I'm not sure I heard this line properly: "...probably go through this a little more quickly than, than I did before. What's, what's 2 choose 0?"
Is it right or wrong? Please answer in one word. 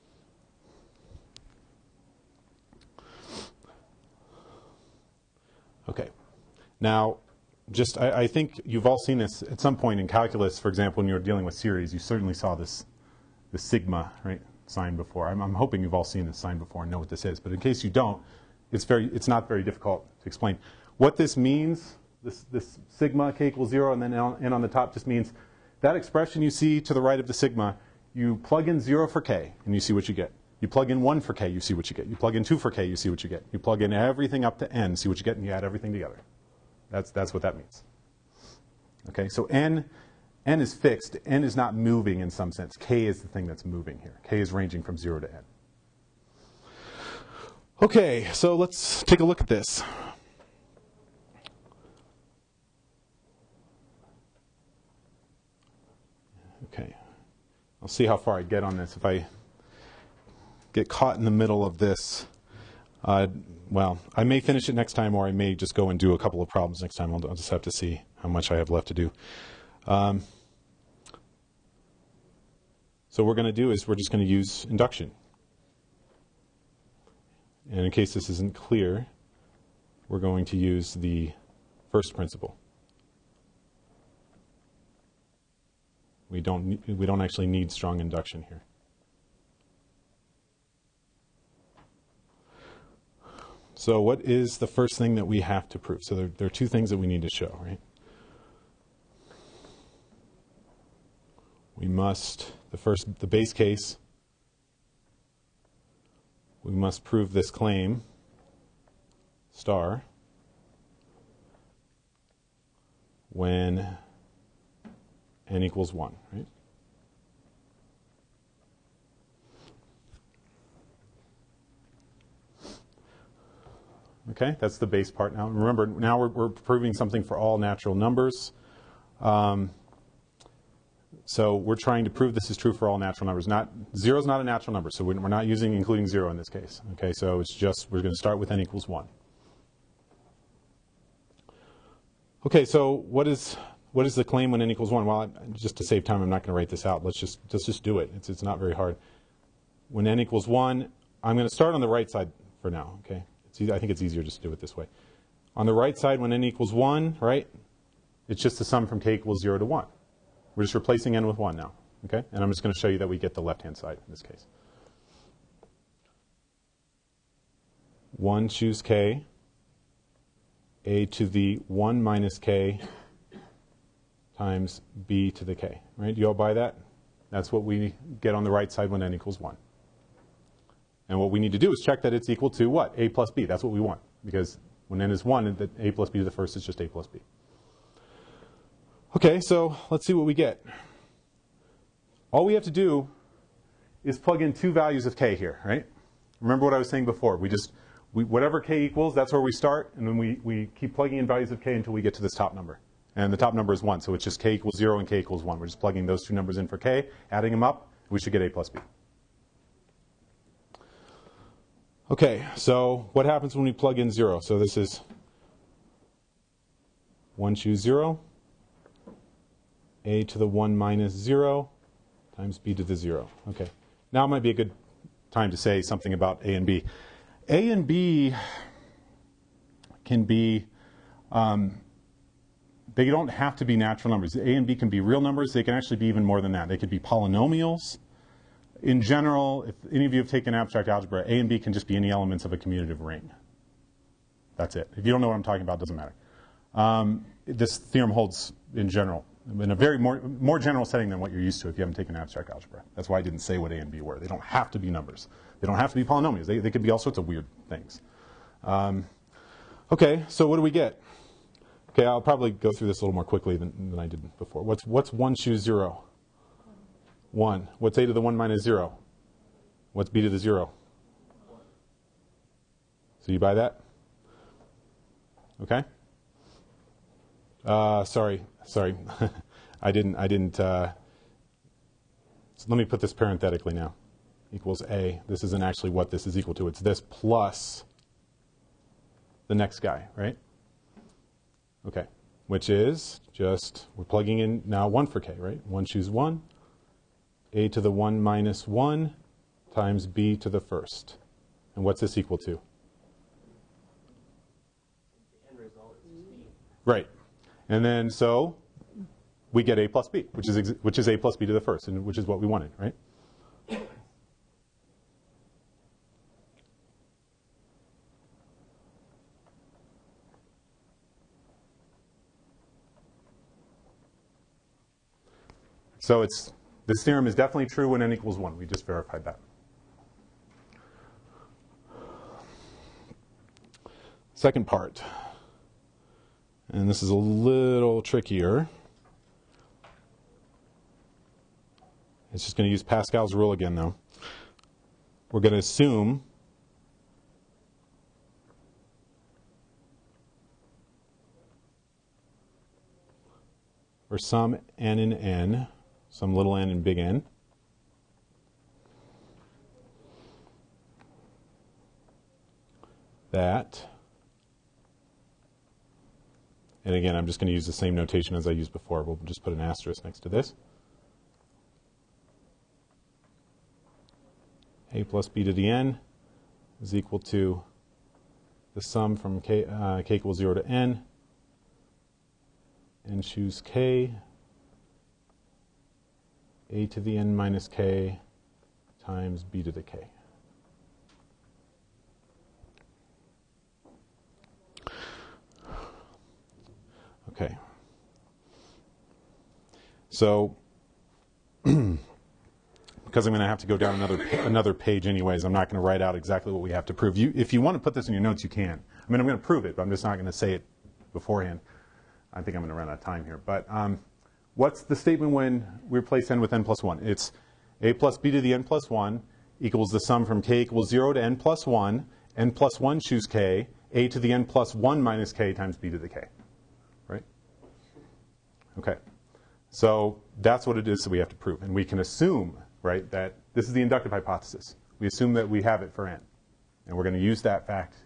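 wrong.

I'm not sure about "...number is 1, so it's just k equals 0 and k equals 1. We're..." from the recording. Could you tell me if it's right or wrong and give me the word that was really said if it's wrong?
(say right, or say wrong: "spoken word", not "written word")
right.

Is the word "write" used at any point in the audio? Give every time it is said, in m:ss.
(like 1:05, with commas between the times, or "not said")
2:26, 6:45.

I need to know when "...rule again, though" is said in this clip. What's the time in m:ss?
5:43.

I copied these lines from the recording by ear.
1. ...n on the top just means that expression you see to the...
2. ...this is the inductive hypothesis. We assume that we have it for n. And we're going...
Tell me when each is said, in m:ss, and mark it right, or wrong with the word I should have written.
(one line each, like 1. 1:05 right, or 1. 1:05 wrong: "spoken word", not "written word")
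1. 0:24 right
2. 7:13 right.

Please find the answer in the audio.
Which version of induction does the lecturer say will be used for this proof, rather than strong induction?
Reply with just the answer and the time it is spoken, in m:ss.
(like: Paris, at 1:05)
The first principle, at 1:20.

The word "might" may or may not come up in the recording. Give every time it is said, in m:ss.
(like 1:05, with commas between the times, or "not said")
3:44.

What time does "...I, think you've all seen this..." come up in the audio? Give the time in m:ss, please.
0:08.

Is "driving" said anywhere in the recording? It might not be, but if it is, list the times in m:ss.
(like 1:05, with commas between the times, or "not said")
not said.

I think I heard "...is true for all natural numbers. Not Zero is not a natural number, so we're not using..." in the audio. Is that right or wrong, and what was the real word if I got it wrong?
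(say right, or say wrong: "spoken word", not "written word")
right.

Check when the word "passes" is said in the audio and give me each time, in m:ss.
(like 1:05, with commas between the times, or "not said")
not said.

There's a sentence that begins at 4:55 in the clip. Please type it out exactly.
1 choose 1, a to the 1 minus 1 times b to the first.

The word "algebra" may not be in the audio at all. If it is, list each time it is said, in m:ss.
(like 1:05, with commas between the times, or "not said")
4:00, 4:12.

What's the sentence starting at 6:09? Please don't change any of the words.
We'll just put an asterisk next to this.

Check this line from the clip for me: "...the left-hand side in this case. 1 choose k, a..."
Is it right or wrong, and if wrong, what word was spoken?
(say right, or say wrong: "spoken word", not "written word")
right.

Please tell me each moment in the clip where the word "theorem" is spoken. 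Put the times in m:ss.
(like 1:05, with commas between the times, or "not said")
4:07, 5:27.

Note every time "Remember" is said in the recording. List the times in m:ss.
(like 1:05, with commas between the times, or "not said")
2:05, 3:16.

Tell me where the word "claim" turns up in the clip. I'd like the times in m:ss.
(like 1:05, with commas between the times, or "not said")
1:47, 2:24.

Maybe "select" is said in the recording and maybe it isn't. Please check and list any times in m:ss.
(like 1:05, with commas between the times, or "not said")
not said.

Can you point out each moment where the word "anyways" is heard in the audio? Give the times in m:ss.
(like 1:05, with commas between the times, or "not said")
6:45.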